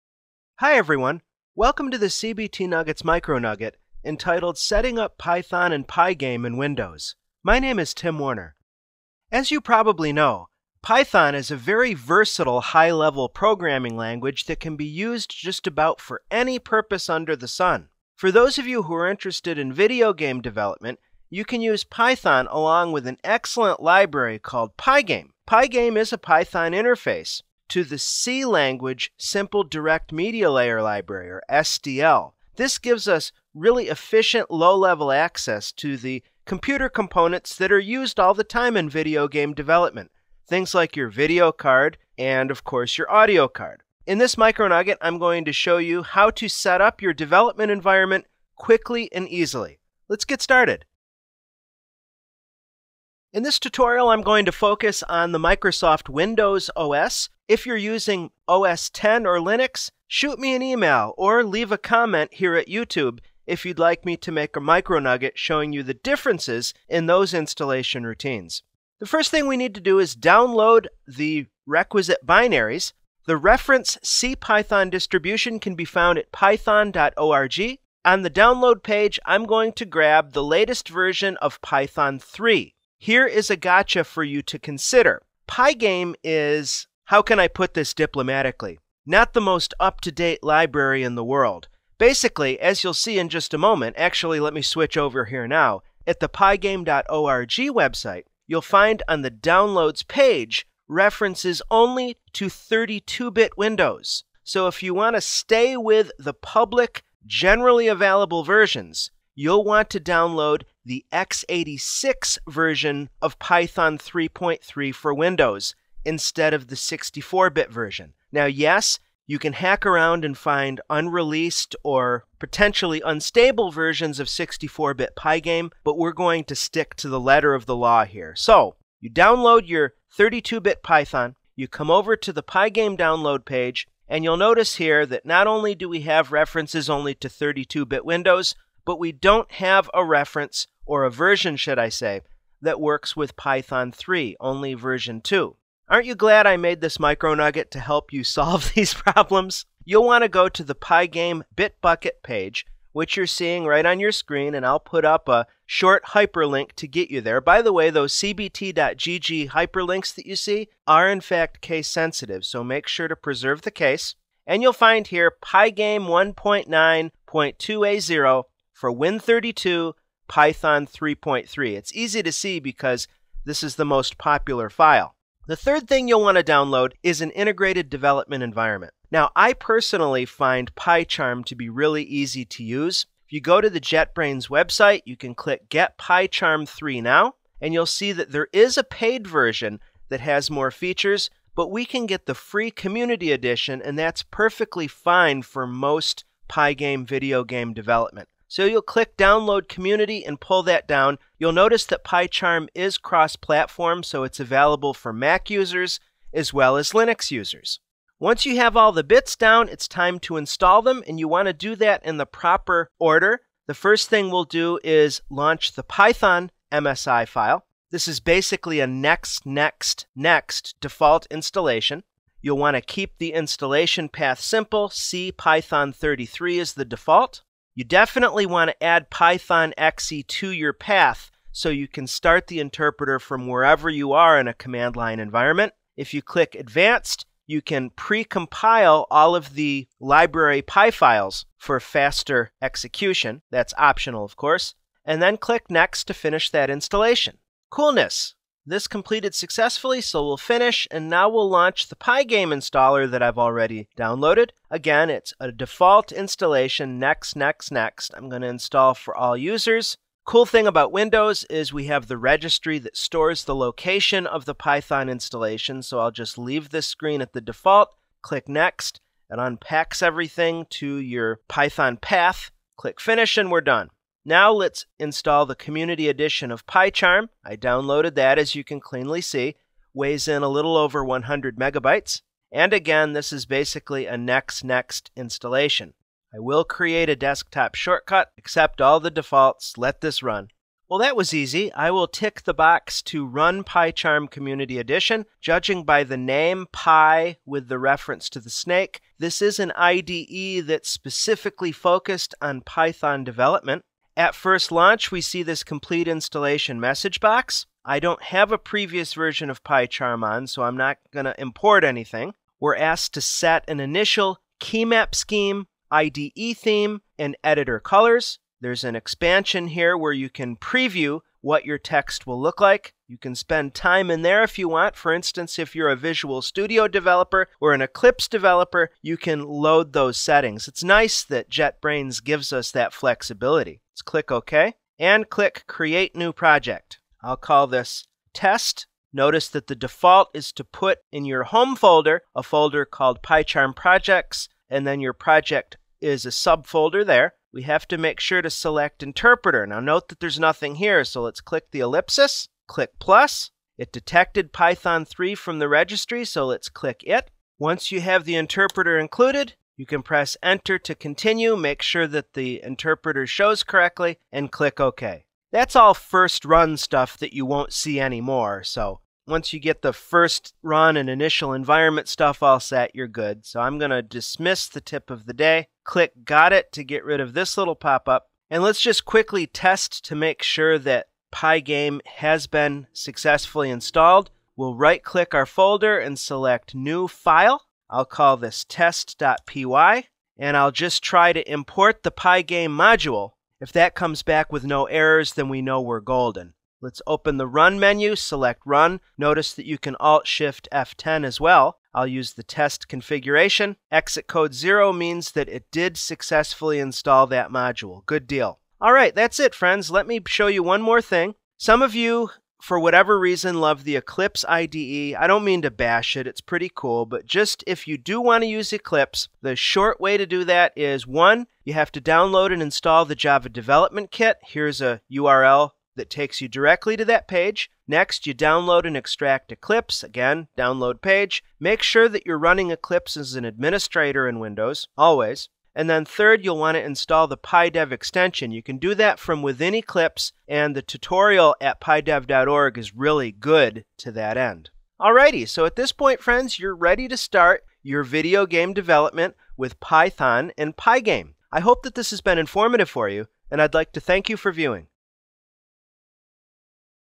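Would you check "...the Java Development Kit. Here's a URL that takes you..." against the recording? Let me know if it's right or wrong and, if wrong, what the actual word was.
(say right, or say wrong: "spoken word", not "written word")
right.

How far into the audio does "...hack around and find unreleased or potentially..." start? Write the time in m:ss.
1:59.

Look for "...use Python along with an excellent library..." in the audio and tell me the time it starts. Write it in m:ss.
0:21.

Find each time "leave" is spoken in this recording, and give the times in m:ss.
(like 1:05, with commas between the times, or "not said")
1:01, 4:26.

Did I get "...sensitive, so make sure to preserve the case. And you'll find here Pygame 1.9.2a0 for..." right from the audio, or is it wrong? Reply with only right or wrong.
right.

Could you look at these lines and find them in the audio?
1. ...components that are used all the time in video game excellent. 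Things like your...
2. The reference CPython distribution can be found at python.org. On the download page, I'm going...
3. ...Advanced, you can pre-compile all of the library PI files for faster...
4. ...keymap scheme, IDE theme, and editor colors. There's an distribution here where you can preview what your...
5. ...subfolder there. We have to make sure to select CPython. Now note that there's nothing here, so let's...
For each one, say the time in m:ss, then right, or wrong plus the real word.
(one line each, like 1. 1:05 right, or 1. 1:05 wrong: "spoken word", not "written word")
1. 0:36 wrong: "development", not "excellent"
2. 1:13 right
3. 3:56 right
4. 5:14 wrong: "expansion", not "distribution"
5. 5:46 wrong: "Interpreter", not "CPython".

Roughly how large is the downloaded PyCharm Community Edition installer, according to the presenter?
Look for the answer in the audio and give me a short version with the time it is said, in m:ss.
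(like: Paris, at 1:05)
100 megabytes, at 4:41.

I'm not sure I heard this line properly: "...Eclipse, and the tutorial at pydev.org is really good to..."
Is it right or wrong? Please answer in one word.
right.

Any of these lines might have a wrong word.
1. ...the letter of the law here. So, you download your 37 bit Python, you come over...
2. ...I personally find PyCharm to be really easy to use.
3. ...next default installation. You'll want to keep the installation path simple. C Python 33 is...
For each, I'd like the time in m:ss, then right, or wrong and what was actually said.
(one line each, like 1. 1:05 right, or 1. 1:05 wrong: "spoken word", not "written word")
1. 2:07 wrong: "32", not "37"
2. 2:59 right
3. 3:40 right.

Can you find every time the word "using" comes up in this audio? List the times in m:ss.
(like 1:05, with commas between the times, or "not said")
0:57.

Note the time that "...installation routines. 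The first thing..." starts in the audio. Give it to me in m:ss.
1:07.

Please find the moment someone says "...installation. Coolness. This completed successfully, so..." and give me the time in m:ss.
4:06.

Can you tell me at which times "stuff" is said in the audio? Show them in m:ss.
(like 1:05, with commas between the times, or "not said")
6:06, 6:12.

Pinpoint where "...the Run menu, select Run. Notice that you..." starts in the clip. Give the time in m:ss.
6:37.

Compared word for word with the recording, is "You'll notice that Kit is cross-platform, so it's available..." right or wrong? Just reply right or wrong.
wrong.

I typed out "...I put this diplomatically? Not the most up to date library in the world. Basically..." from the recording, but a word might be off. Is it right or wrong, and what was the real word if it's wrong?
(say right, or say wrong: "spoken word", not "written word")
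right.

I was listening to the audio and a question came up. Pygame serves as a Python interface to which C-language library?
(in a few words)
Simple Direct Media Layer.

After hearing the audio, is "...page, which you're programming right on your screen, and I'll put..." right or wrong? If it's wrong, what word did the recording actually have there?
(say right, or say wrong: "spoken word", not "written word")
wrong: "seeing", not "programming".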